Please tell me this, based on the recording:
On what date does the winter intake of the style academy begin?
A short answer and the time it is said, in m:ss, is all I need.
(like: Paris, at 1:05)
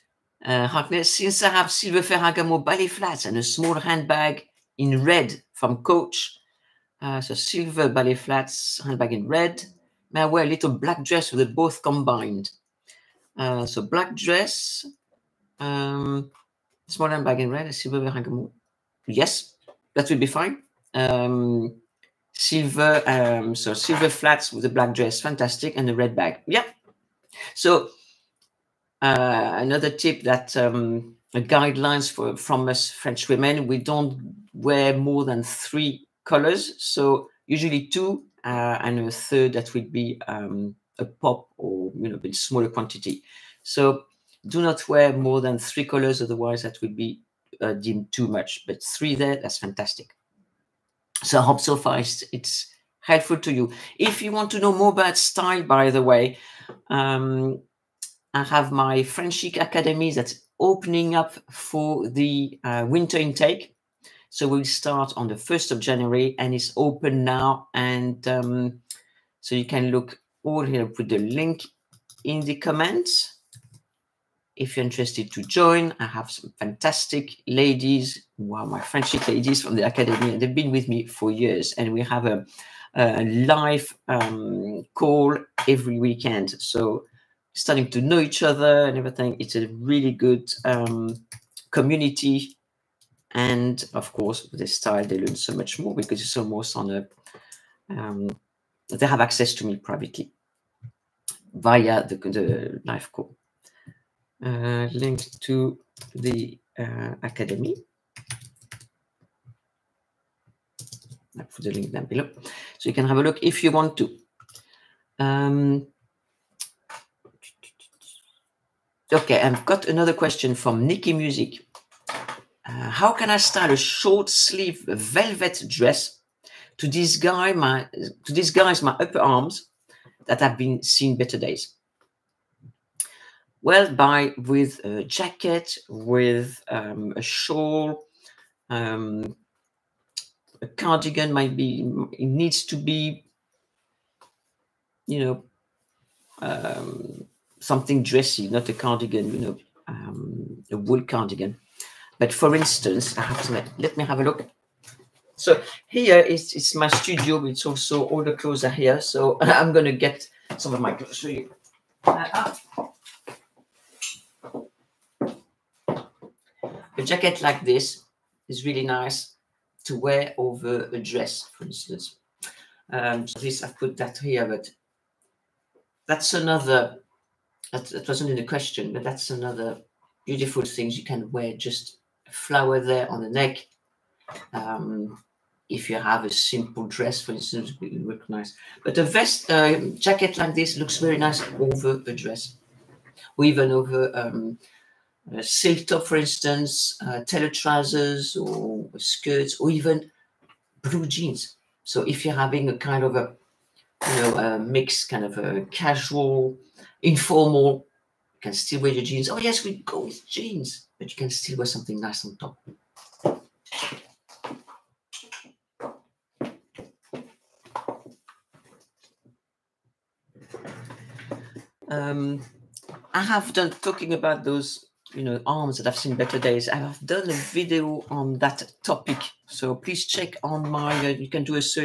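1st of January, at 1:05.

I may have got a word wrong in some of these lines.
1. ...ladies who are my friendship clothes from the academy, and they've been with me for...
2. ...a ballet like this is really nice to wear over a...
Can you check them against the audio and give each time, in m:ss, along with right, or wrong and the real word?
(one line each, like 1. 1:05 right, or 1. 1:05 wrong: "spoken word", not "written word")
1. 1:17 wrong: "ladies", not "clothes"
2. 2:46 wrong: "jacket", not "ballet".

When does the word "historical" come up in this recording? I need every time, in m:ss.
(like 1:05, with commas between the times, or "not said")
not said.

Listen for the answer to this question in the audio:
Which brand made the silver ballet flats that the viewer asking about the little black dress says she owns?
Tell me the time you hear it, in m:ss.
0:02.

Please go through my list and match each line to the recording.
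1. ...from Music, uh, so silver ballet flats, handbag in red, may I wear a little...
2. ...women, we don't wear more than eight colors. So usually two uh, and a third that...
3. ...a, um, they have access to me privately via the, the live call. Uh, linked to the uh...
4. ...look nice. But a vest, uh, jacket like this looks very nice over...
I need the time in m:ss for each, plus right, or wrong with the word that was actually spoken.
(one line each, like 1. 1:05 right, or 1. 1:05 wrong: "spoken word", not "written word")
1. 0:05 wrong: "Coach", not "Music"
2. 0:33 wrong: "three", not "eight"
3. 1:36 right
4. 3:08 right.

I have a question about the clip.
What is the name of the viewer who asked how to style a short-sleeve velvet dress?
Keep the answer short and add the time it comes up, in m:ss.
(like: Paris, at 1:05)
Nikki Music, at 2:00.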